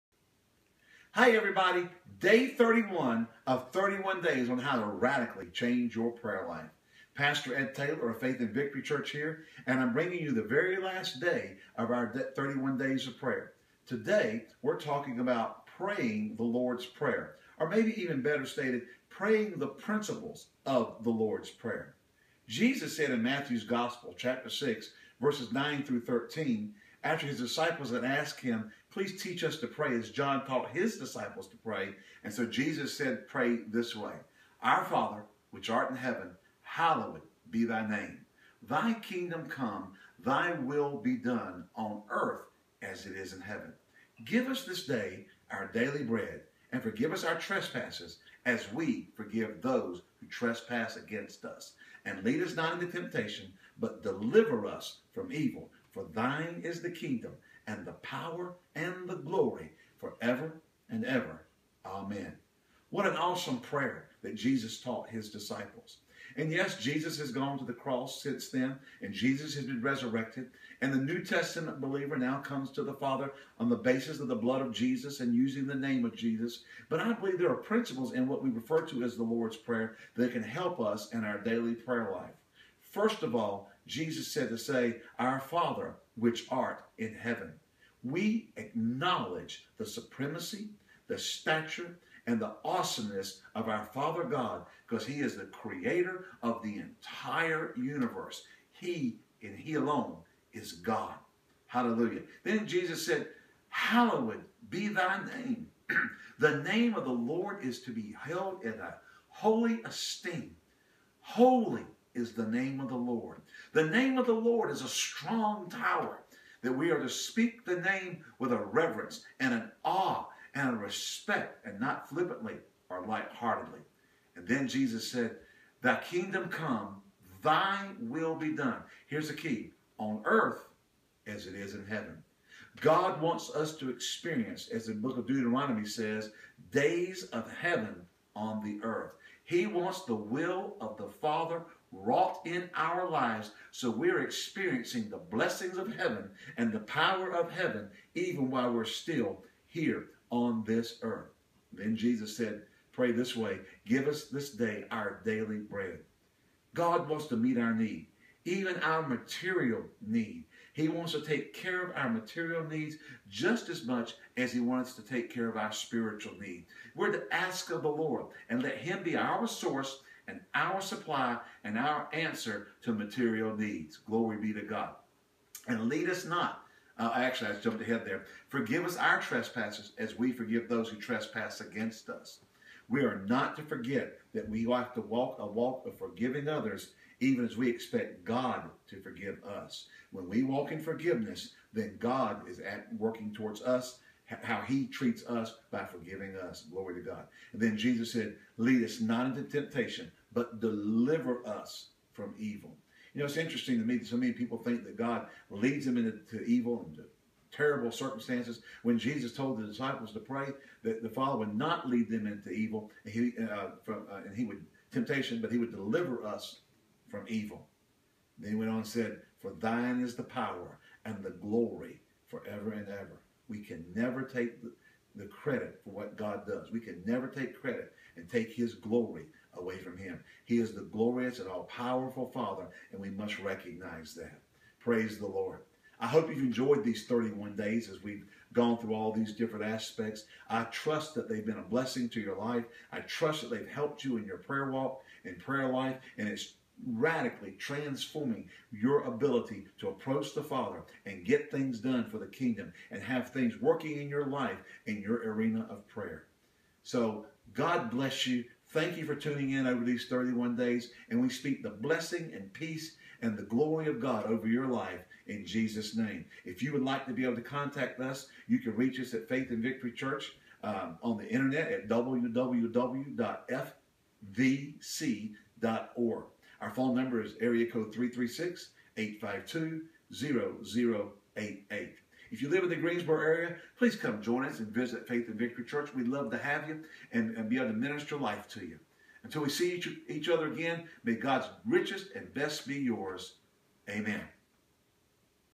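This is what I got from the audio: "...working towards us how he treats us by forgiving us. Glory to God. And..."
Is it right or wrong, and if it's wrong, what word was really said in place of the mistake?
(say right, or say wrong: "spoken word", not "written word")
right.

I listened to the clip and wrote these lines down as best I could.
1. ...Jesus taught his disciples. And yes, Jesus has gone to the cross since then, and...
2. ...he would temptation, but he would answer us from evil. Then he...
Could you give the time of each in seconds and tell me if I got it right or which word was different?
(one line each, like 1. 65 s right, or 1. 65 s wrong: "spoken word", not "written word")
1. 64 s right
2. 214 s wrong: "deliver", not "answer".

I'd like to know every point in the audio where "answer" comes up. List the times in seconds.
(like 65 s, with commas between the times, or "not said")
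172 s.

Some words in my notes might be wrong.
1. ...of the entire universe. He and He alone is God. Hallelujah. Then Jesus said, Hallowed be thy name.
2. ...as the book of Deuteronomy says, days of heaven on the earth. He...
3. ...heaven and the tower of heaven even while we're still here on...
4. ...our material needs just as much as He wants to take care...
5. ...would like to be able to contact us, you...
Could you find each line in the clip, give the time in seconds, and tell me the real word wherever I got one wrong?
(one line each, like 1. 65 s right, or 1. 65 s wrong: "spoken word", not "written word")
1. 96 s right
2. 134 s right
3. 145 s wrong: "power", not "tower"
4. 161 s right
5. 266 s right.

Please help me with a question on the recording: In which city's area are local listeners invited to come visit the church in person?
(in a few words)
Greensboro.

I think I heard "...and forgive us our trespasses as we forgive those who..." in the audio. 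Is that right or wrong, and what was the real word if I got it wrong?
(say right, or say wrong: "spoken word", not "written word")
right.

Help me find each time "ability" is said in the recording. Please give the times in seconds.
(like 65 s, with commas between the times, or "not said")
249 s.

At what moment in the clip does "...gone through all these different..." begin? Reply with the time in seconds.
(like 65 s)
238 s.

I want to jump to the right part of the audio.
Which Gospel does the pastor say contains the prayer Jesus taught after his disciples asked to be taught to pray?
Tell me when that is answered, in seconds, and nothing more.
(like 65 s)
23 s.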